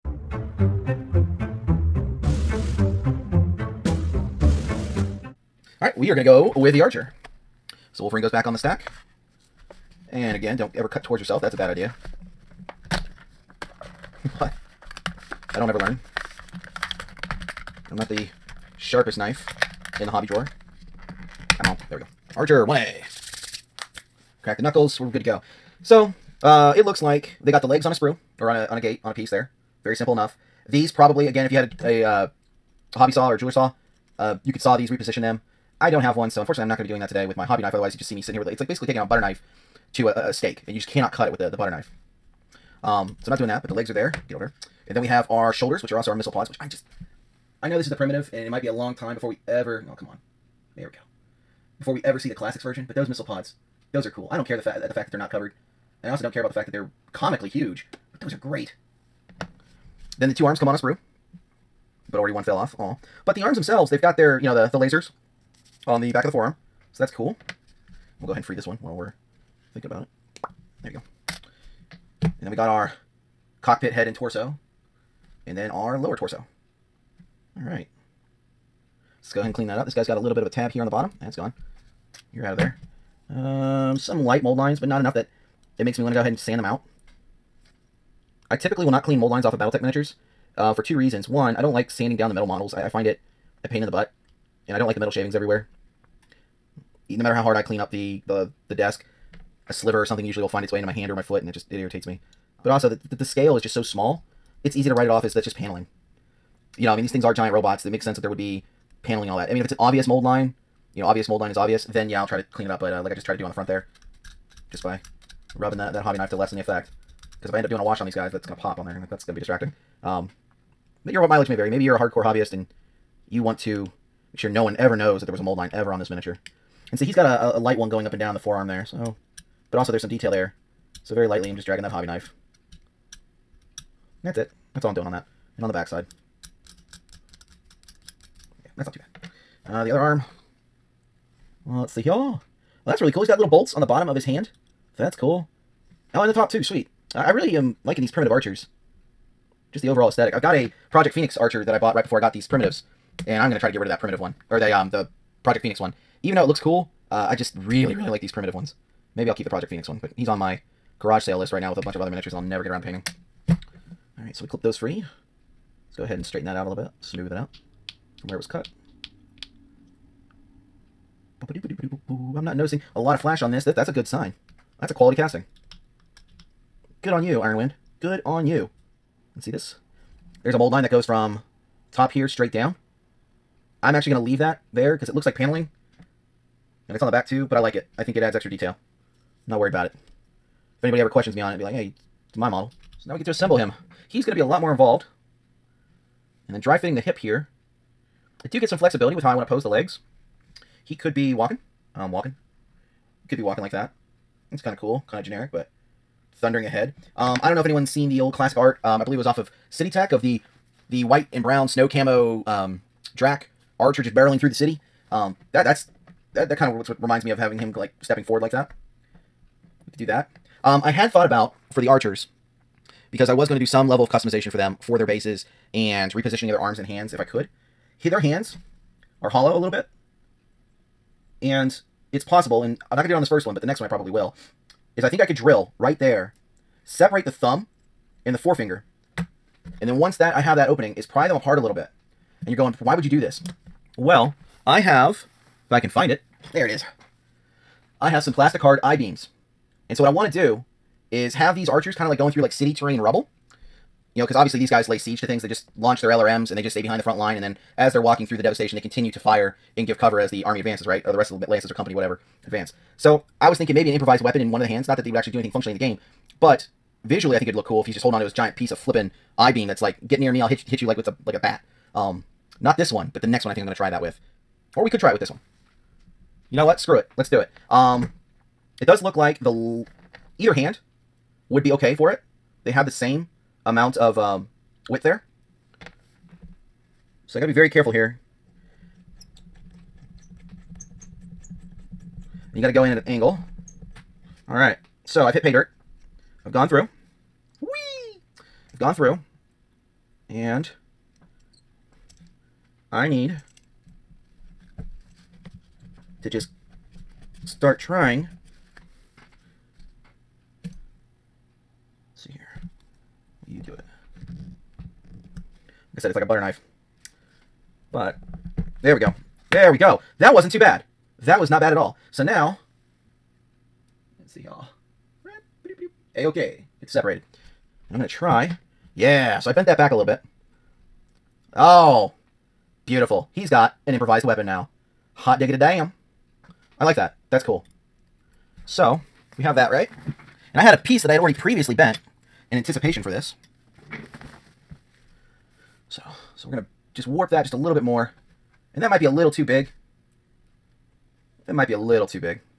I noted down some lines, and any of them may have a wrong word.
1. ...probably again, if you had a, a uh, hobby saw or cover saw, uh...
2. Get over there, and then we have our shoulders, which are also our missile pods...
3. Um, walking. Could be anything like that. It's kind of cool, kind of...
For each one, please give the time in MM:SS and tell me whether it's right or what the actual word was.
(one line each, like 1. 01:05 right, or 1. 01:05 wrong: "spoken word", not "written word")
1. 00:30 wrong: "jeweler", not "cover"
2. 00:44 right
3. 03:21 wrong: "walking", not "anything".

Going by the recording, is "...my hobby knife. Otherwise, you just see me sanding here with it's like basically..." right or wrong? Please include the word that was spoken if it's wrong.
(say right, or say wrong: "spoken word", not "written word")
wrong: "sitting", not "sanding".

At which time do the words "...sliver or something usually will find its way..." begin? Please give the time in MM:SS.
01:39.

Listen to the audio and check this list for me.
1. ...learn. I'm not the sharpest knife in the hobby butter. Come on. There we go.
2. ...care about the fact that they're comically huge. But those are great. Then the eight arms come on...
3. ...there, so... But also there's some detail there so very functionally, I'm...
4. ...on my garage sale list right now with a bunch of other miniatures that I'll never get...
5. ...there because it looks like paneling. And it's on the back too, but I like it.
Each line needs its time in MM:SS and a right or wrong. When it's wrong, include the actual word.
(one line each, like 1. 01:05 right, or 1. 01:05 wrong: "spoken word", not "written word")
1. 00:15 wrong: "drawer", not "butter"
2. 00:56 wrong: "two", not "eight"
3. 02:08 wrong: "lightly", not "functionally"
4. 02:40 right
5. 03:04 right.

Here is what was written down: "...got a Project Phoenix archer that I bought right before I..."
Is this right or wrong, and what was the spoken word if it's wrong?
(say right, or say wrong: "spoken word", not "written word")
right.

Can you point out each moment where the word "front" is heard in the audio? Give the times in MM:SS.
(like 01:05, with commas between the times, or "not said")
01:53, 04:17.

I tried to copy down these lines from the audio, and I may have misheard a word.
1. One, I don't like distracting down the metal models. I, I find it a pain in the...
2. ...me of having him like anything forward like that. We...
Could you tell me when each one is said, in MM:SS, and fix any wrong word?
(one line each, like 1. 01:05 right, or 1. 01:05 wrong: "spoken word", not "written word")
1. 01:31 wrong: "sanding", not "distracting"
2. 03:37 wrong: "stepping", not "anything".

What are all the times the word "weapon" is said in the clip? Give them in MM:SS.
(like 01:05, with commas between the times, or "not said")
04:24, 05:34.